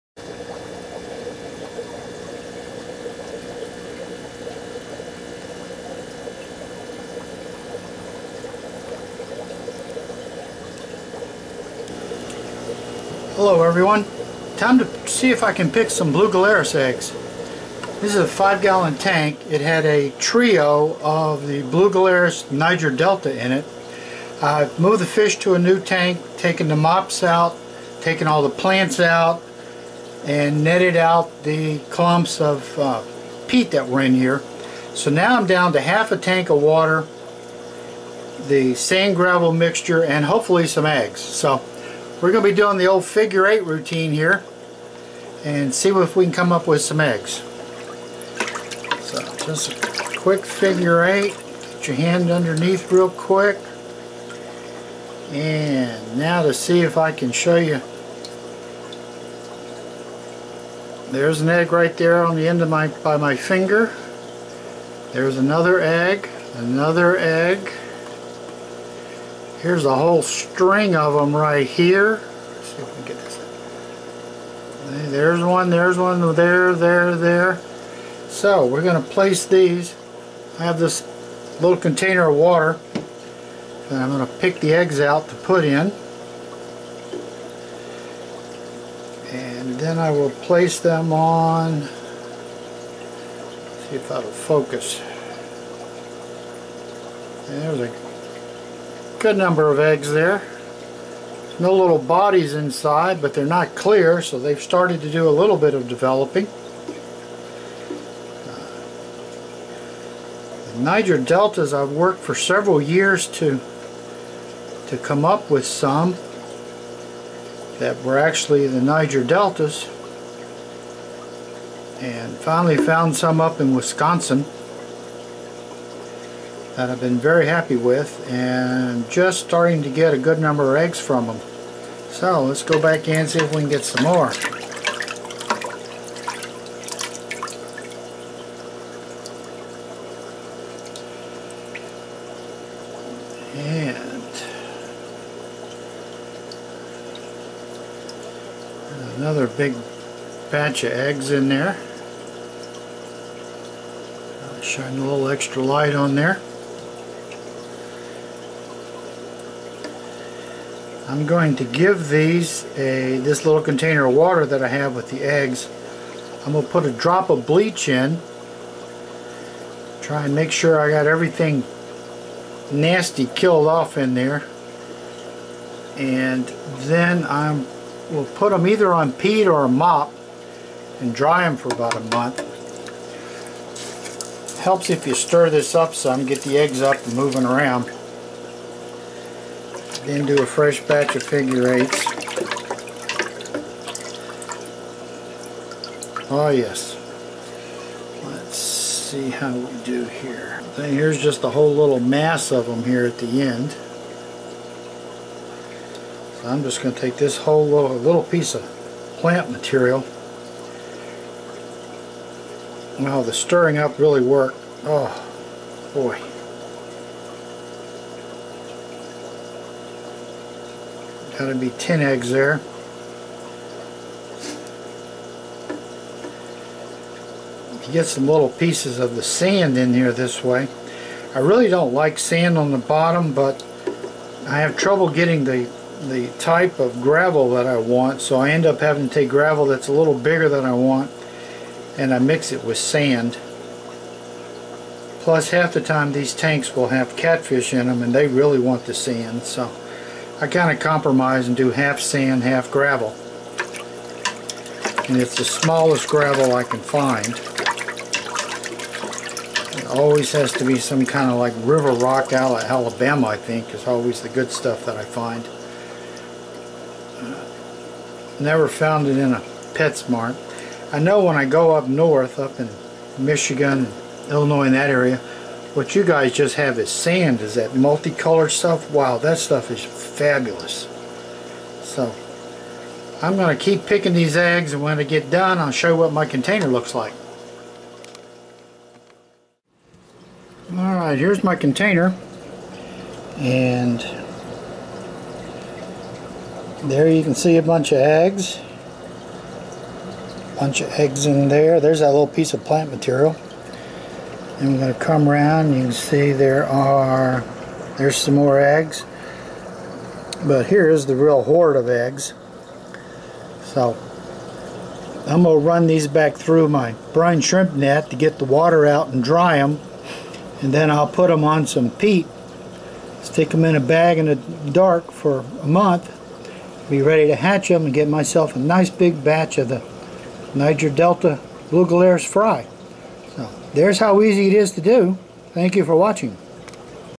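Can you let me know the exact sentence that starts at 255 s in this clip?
And it's the smallest gravel I can find.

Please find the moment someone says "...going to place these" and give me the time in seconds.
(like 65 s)
78 s.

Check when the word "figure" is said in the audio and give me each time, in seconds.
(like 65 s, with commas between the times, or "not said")
43 s, 50 s, 191 s.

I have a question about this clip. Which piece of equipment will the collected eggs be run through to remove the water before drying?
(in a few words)
Brine shrimp net.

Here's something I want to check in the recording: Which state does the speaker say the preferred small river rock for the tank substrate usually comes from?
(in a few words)
Alabama.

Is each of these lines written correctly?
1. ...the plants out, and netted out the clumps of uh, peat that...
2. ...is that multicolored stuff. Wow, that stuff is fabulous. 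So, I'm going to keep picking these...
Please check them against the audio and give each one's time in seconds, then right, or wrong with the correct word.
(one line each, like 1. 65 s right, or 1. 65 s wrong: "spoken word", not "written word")
1. 28 s right
2. 277 s right.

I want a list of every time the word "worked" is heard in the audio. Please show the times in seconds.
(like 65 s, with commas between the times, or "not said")
111 s, 214 s.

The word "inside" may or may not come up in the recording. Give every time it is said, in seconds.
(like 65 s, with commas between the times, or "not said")
102 s.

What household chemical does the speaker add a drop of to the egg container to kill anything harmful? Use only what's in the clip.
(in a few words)
Bleach.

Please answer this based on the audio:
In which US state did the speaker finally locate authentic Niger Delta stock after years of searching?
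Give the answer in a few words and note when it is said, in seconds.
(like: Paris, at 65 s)
Wisconsin, at 123 s.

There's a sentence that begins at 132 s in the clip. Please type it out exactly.
So let's go back in and see if we can get some more.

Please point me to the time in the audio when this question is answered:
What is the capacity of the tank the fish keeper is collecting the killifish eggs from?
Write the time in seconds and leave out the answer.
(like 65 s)
18 s.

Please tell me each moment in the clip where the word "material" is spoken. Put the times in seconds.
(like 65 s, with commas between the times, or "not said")
209 s, 302 s.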